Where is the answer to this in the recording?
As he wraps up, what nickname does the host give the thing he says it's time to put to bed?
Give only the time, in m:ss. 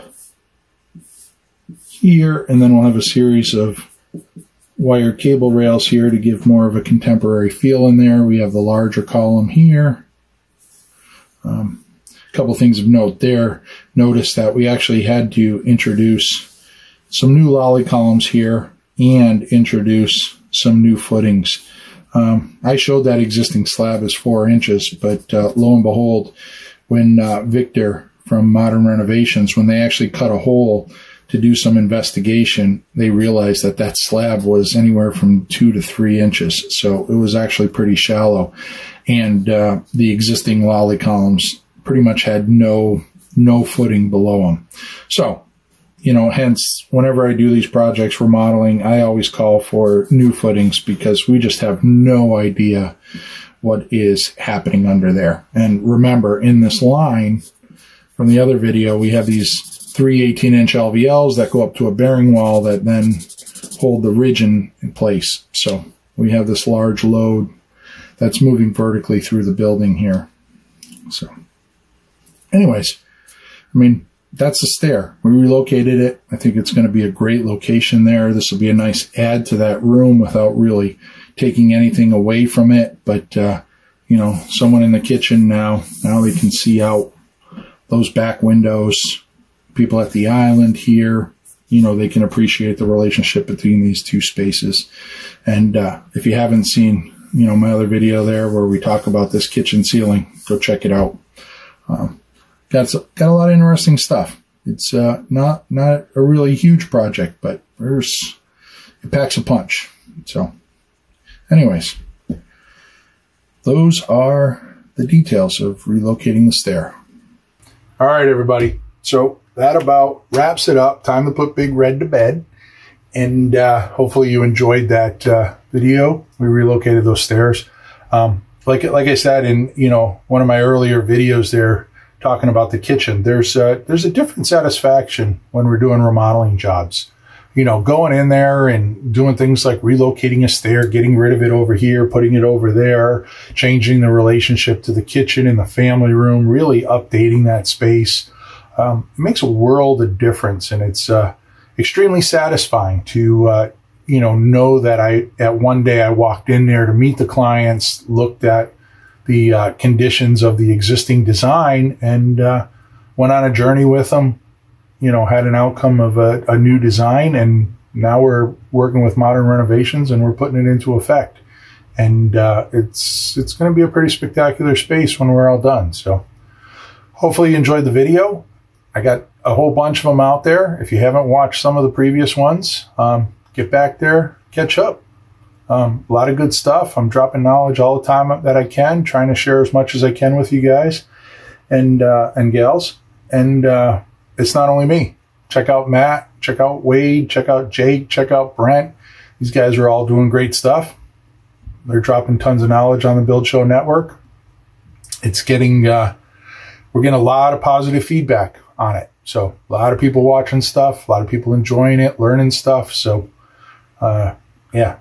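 2:01.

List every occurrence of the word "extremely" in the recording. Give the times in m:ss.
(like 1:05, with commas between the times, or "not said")
2:31.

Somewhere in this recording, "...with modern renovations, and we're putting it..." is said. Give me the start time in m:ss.
2:49.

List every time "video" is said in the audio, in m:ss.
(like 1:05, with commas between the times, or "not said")
0:58, 1:37, 2:05, 2:11, 2:57.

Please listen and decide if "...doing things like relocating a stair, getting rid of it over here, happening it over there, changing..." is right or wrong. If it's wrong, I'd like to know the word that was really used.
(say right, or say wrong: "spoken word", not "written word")
wrong: "putting", not "happening".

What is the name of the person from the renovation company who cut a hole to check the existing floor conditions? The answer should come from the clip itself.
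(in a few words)
Victor.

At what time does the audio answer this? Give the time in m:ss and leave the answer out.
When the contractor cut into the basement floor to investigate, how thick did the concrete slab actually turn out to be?
0:35.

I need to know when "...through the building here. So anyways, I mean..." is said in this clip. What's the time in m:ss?
1:09.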